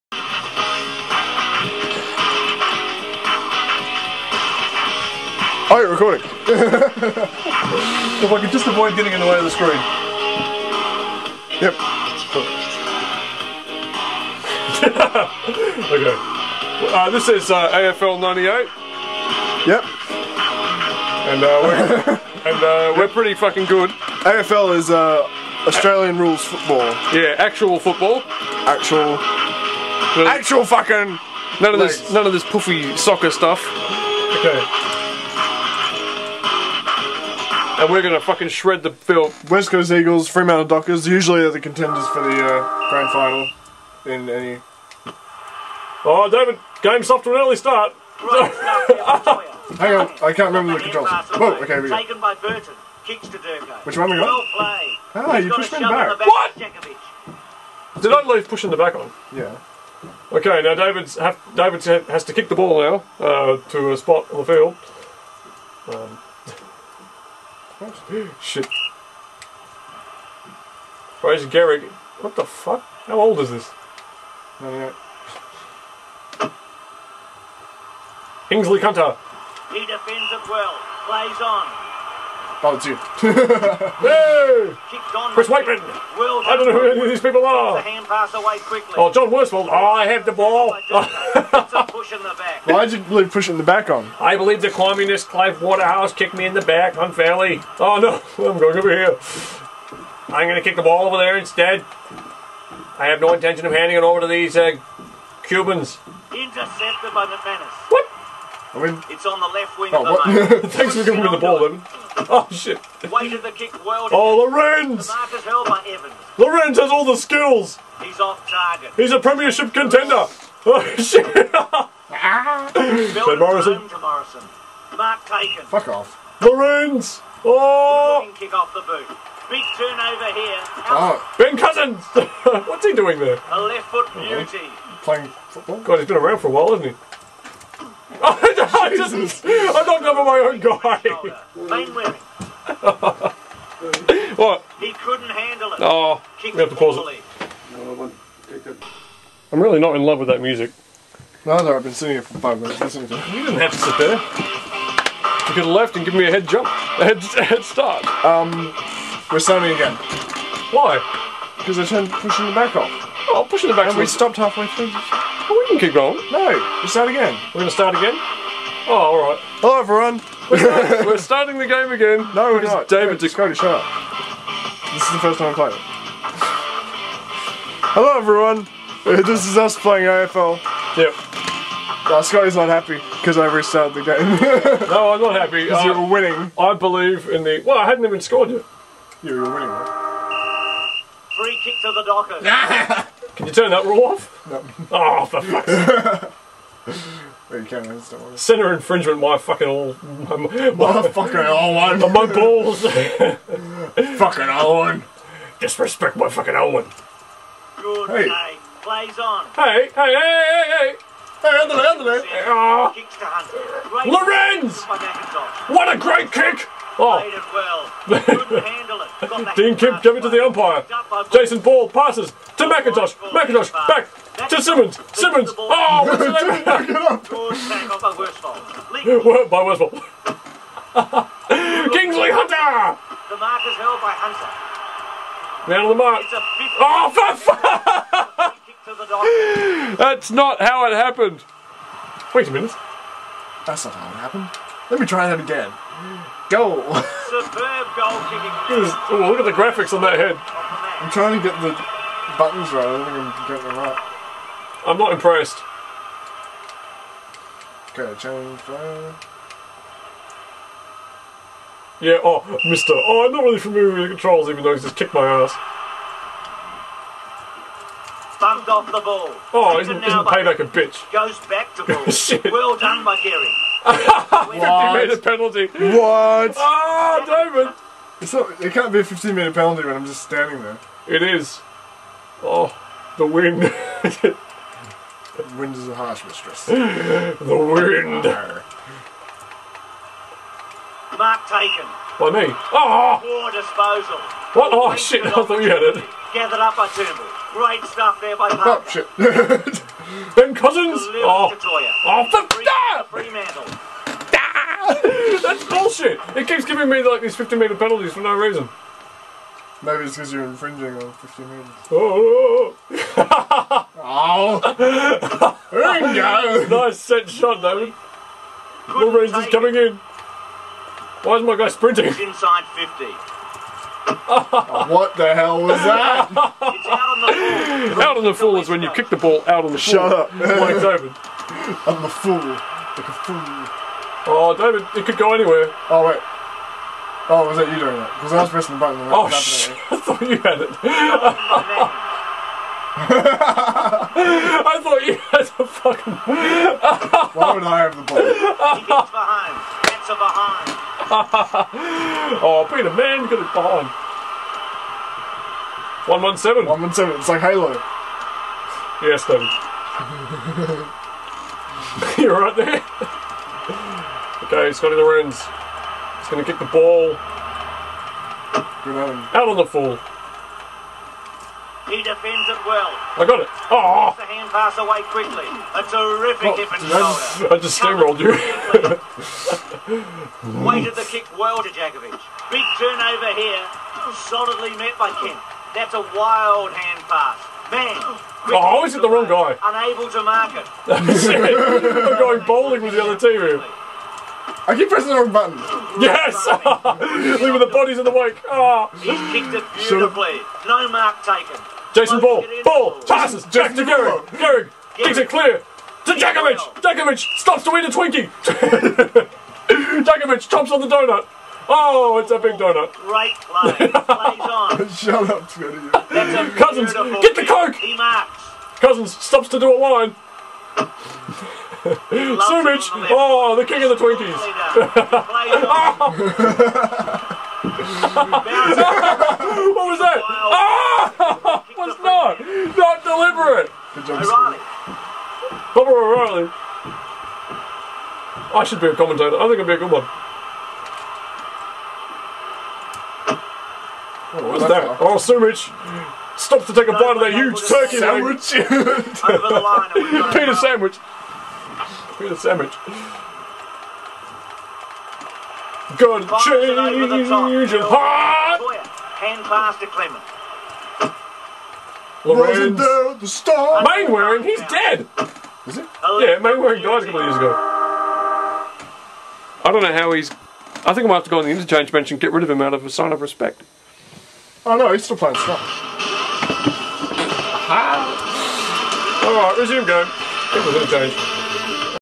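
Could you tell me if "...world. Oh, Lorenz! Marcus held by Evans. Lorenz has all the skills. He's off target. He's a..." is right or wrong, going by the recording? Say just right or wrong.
right.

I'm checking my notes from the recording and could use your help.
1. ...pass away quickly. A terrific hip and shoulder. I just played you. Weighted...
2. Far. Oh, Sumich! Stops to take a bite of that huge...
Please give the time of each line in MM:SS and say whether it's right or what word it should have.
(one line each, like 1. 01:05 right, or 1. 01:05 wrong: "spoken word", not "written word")
1. 06:14 wrong: "steamrolled", not "played"
2. 07:24 right.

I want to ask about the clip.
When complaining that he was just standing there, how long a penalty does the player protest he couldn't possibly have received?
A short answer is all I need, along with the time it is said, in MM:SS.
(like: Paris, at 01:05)
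15 minutes, at 04:39.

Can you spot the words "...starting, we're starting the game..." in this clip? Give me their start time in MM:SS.
02:50.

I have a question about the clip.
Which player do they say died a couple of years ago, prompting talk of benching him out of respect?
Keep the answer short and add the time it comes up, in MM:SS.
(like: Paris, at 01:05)
Mainwaring, at 07:46.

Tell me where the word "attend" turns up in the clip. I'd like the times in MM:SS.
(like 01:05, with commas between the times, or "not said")
not said.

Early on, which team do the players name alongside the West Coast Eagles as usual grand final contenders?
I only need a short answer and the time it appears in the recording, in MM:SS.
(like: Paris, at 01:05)
Fremantle Dockers, at 00:40.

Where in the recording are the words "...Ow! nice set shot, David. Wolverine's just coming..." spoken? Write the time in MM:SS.
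05:13.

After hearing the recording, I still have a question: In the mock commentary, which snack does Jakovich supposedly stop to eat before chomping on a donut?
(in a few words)
A Twinkie.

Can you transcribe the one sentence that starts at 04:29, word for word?
Oh, he's isn't, isn't payback a bitch?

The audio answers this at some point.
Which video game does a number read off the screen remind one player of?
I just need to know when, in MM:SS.
05:57.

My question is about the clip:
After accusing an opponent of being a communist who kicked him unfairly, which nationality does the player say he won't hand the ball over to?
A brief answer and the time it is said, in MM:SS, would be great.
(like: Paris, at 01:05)
Cubans, at 01:45.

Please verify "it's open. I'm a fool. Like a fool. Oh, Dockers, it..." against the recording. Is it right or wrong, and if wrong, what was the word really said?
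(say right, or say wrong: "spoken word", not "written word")
wrong: "David", not "Dockers".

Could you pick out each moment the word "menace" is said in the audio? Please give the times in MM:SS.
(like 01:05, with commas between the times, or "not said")
01:47.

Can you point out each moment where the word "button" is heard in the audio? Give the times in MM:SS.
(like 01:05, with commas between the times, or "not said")
04:12, 05:38, 06:35.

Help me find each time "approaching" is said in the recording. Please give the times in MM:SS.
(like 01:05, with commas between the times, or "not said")
not said.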